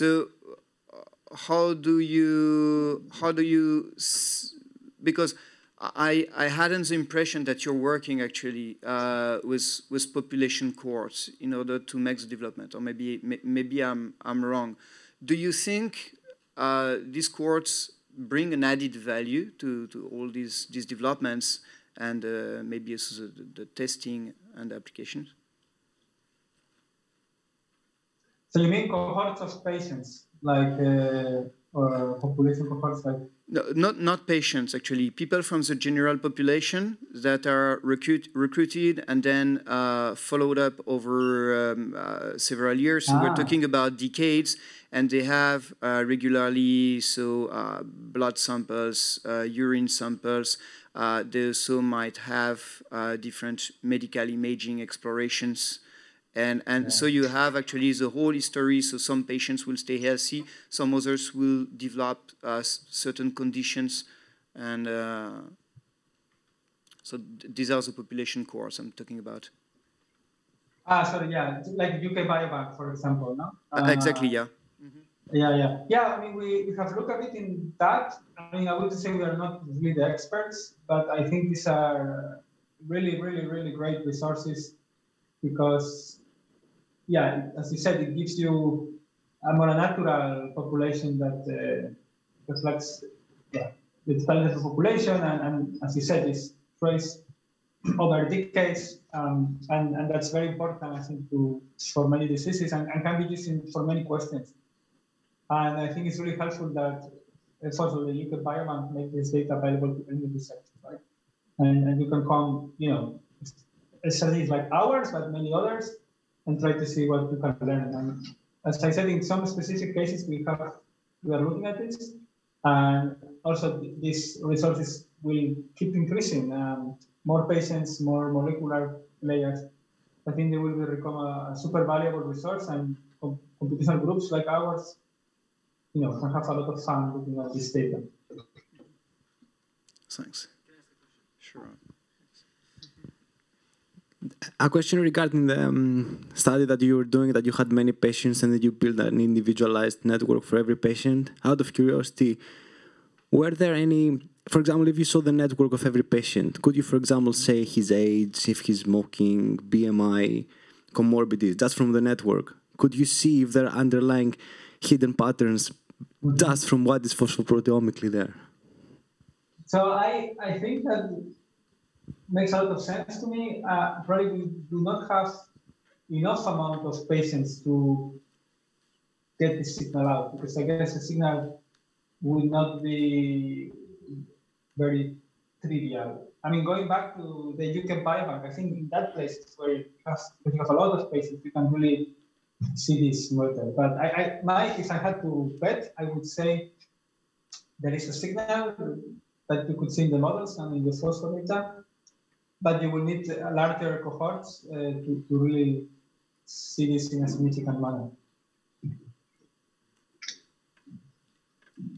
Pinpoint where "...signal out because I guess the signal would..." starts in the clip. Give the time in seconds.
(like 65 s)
179 s.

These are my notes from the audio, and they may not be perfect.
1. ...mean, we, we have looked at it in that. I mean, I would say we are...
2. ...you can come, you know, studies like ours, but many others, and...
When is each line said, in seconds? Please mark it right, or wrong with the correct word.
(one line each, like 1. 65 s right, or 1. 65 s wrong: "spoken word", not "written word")
1. 76 s right
2. 112 s right.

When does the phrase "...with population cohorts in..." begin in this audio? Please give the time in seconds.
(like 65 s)
9 s.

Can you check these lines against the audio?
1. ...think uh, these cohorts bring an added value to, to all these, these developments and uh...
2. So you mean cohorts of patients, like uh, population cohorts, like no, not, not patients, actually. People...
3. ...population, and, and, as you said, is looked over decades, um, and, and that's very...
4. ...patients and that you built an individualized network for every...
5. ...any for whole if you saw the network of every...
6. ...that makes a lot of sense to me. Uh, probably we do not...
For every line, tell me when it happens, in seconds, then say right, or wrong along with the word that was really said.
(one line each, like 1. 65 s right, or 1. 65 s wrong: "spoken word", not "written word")
1. 15 s right
2. 28 s right
3. 94 s wrong: "traced", not "looked"
4. 147 s right
5. 153 s wrong: "example", not "whole"
6. 170 s right.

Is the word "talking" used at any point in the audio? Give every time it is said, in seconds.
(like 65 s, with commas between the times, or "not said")
43 s, 68 s.